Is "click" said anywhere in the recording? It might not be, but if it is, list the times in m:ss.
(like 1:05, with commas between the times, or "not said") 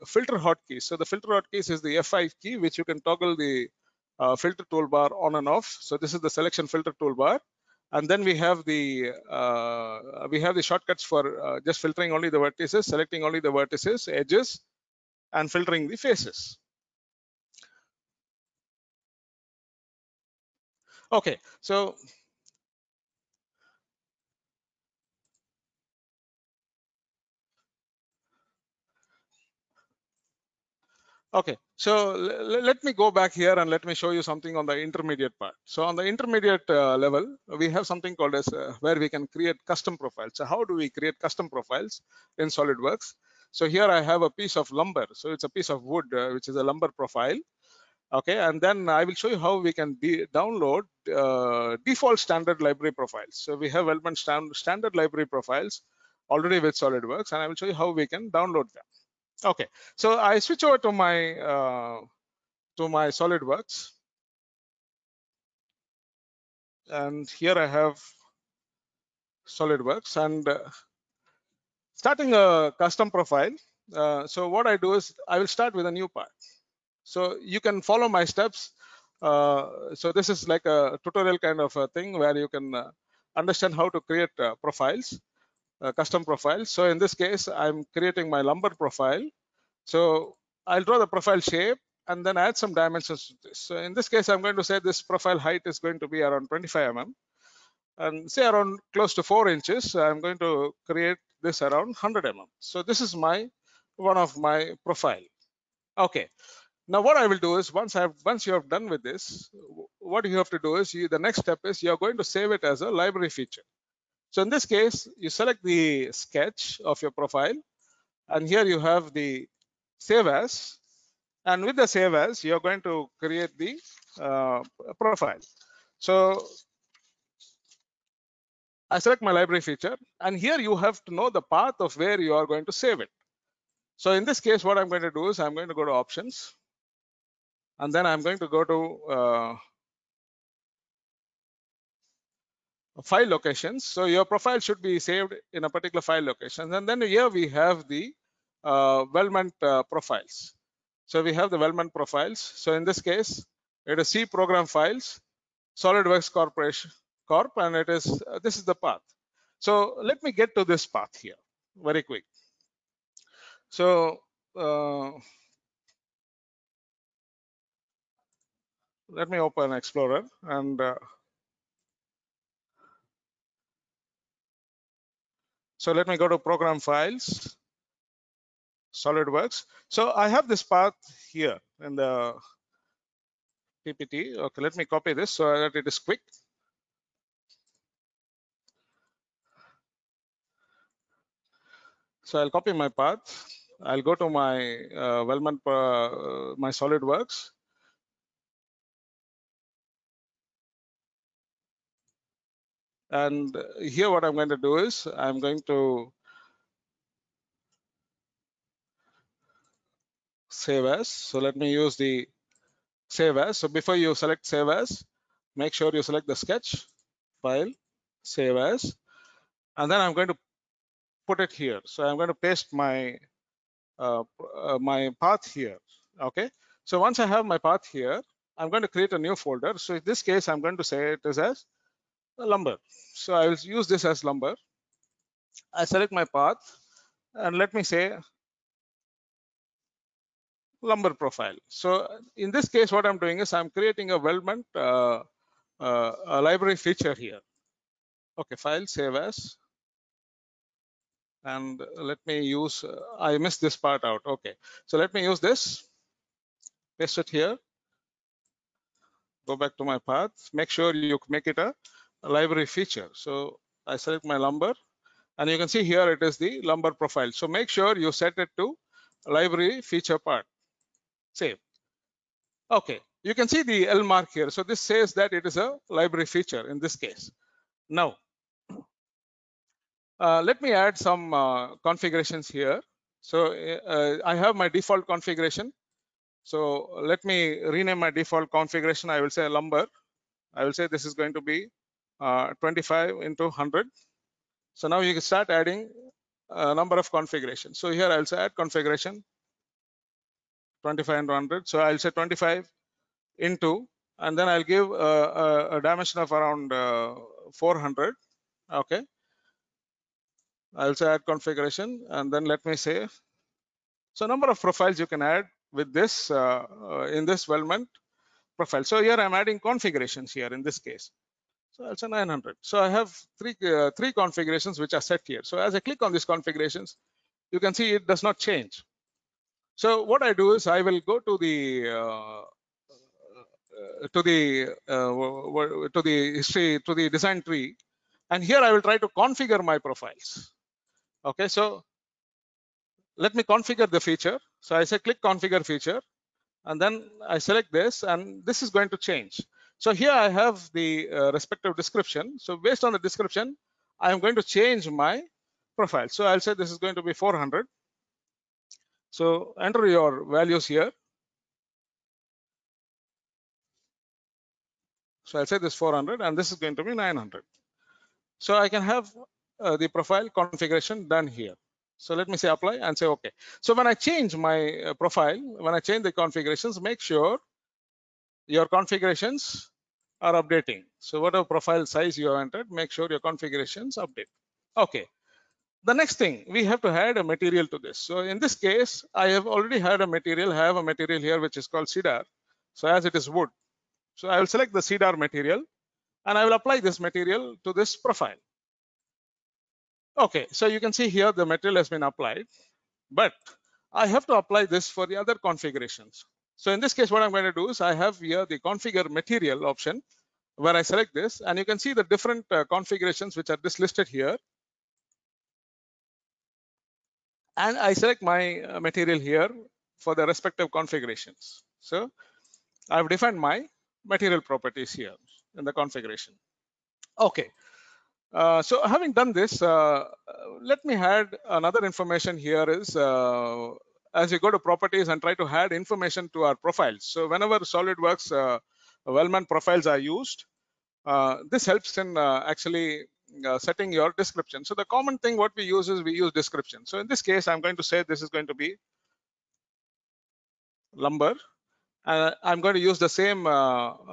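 5:25, 5:44.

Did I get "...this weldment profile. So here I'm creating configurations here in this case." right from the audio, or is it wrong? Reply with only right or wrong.
wrong.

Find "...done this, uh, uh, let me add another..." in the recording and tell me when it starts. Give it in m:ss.
7:09.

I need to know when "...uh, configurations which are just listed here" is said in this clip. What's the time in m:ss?
6:52.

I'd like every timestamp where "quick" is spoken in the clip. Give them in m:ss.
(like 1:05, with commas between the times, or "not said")
2:42, 3:05.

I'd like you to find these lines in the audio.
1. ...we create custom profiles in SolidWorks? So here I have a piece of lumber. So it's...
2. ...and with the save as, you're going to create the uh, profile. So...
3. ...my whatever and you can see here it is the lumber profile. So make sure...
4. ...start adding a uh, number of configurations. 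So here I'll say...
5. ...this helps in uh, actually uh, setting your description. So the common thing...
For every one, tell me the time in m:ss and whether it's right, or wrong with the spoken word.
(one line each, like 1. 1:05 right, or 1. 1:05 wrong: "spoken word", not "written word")
1. 0:40 right
2. 2:01 right
3. 4:24 wrong: "lumber", not "whatever"
4. 4:55 right
5. 7:21 right.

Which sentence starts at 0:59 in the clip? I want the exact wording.
Okay, so I switch over to my uh, to my SolidWorks, and here I have SolidWorks and uh, starting a custom profile.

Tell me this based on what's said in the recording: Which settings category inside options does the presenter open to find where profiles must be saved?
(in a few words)
File locations.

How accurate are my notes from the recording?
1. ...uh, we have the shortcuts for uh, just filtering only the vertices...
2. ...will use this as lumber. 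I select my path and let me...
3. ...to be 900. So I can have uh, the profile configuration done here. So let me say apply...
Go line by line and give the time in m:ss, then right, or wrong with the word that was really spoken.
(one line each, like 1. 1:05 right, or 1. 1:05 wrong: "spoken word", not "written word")
1. 0:09 right
2. 3:53 right
3. 6:06 right.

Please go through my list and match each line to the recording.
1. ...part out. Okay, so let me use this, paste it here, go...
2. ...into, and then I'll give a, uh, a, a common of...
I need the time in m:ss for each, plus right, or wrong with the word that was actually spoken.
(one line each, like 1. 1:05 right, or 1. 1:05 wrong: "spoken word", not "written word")
1. 4:13 right
2. 5:03 wrong: "dimension", not "common".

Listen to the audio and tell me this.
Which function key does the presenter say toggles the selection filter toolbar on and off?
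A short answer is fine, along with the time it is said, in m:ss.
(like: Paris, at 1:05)
F5, at 0:01.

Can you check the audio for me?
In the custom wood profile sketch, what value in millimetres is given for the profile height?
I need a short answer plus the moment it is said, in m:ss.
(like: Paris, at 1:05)
25 mm, at 1:36.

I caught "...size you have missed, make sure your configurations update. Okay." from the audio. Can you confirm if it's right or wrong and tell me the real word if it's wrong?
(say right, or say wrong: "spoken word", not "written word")
wrong: "entered", not "missed".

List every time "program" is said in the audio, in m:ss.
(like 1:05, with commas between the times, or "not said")
2:34, 2:56.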